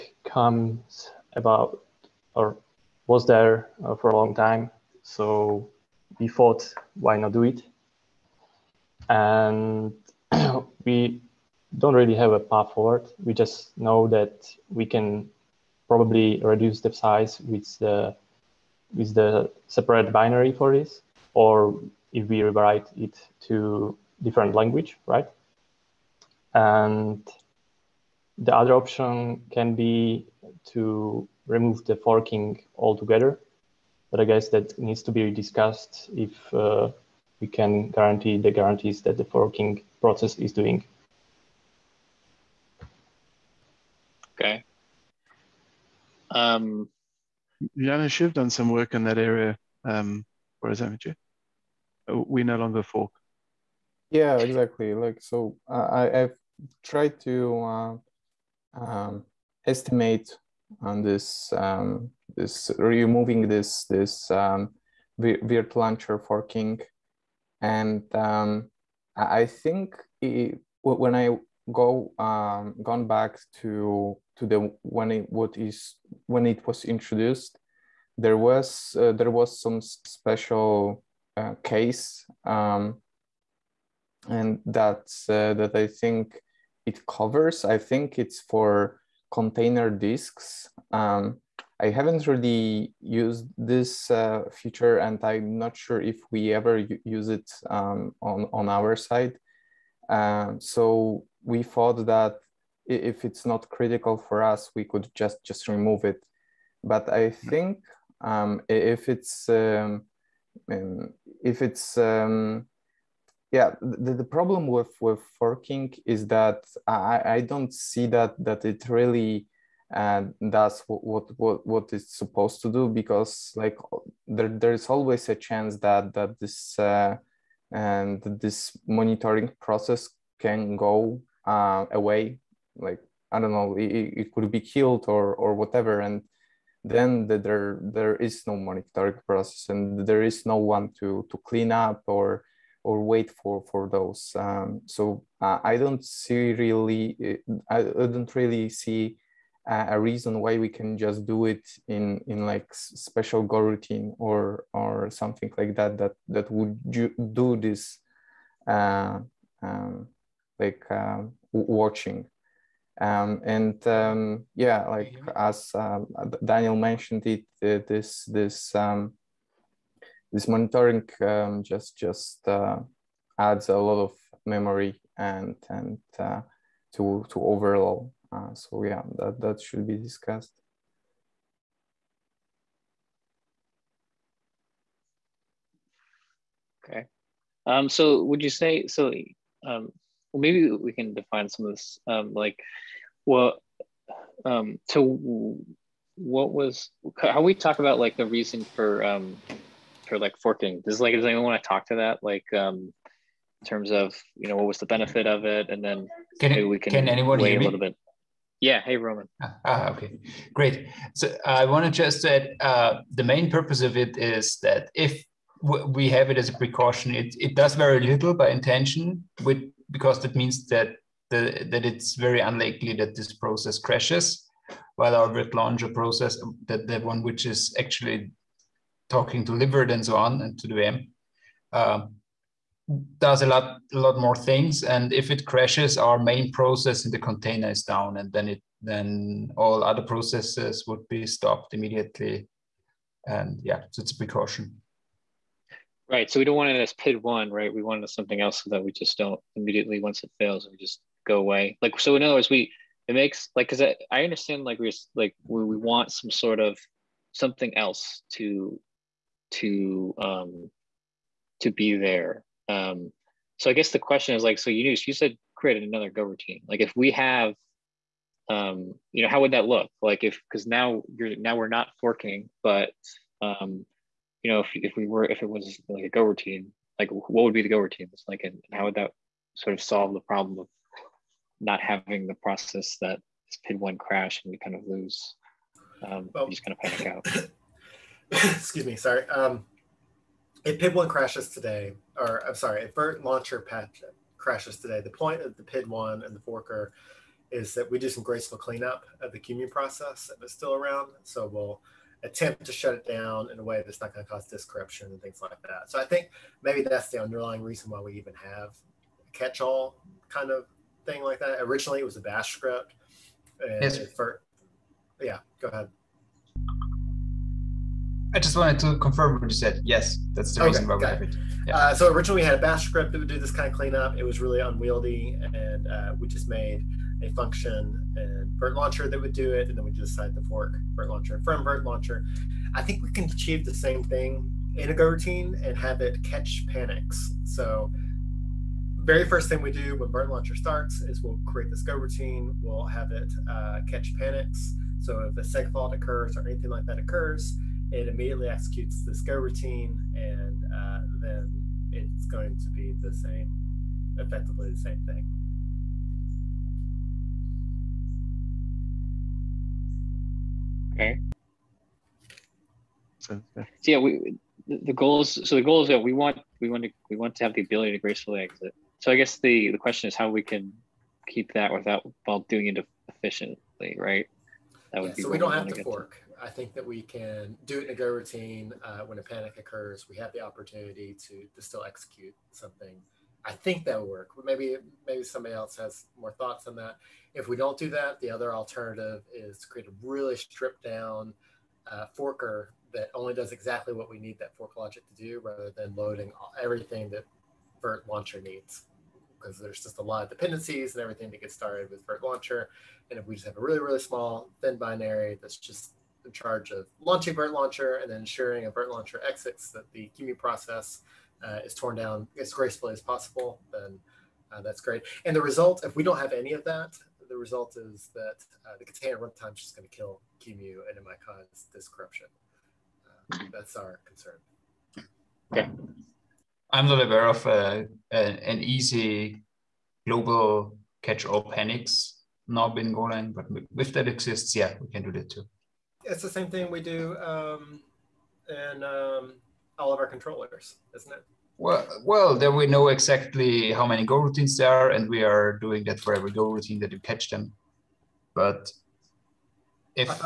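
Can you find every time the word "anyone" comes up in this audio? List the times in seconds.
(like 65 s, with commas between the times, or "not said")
201 s, 207 s.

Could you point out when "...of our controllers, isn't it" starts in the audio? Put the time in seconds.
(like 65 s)
439 s.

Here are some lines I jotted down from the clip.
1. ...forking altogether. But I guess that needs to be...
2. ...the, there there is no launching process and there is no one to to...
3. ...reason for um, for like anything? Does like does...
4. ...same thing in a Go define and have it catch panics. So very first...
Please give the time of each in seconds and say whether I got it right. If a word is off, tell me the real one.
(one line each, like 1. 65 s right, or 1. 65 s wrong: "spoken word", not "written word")
1. 31 s right
2. 137 s wrong: "monitoring", not "launching"
3. 198 s wrong: "forking", not "anything"
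4. 333 s wrong: "routine", not "define".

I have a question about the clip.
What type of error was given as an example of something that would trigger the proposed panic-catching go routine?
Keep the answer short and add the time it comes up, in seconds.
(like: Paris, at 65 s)
seg fault, at 345 s.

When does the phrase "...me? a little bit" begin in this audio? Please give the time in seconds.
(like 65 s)
207 s.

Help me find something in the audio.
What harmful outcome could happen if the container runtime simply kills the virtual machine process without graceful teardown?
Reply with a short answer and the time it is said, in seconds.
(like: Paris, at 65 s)
disk corruption, at 304 s.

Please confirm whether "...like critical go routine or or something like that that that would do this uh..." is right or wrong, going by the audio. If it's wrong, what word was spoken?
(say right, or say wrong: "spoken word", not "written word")
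wrong: "special", not "critical".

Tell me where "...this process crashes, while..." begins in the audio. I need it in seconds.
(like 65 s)
223 s.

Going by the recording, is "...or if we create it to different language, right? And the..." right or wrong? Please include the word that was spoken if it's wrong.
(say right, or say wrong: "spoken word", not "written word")
wrong: "rewrite", not "create".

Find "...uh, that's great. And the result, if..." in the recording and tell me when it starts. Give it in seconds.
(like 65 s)
414 s.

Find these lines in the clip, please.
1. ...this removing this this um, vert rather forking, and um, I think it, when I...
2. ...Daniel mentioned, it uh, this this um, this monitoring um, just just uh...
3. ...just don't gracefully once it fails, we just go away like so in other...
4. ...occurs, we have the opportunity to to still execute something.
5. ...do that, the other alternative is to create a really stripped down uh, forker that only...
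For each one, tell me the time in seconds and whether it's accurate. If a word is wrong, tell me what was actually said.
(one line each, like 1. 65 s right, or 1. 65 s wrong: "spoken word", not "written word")
1. 62 s wrong: "launcher", not "rather"
2. 166 s right
3. 248 s wrong: "immediately", not "gracefully"
4. 379 s right
5. 387 s right.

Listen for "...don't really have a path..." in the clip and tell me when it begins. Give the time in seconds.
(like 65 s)
11 s.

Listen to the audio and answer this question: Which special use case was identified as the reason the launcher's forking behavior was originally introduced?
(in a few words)
container disks.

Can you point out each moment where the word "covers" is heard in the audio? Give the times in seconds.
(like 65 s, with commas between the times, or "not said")
87 s.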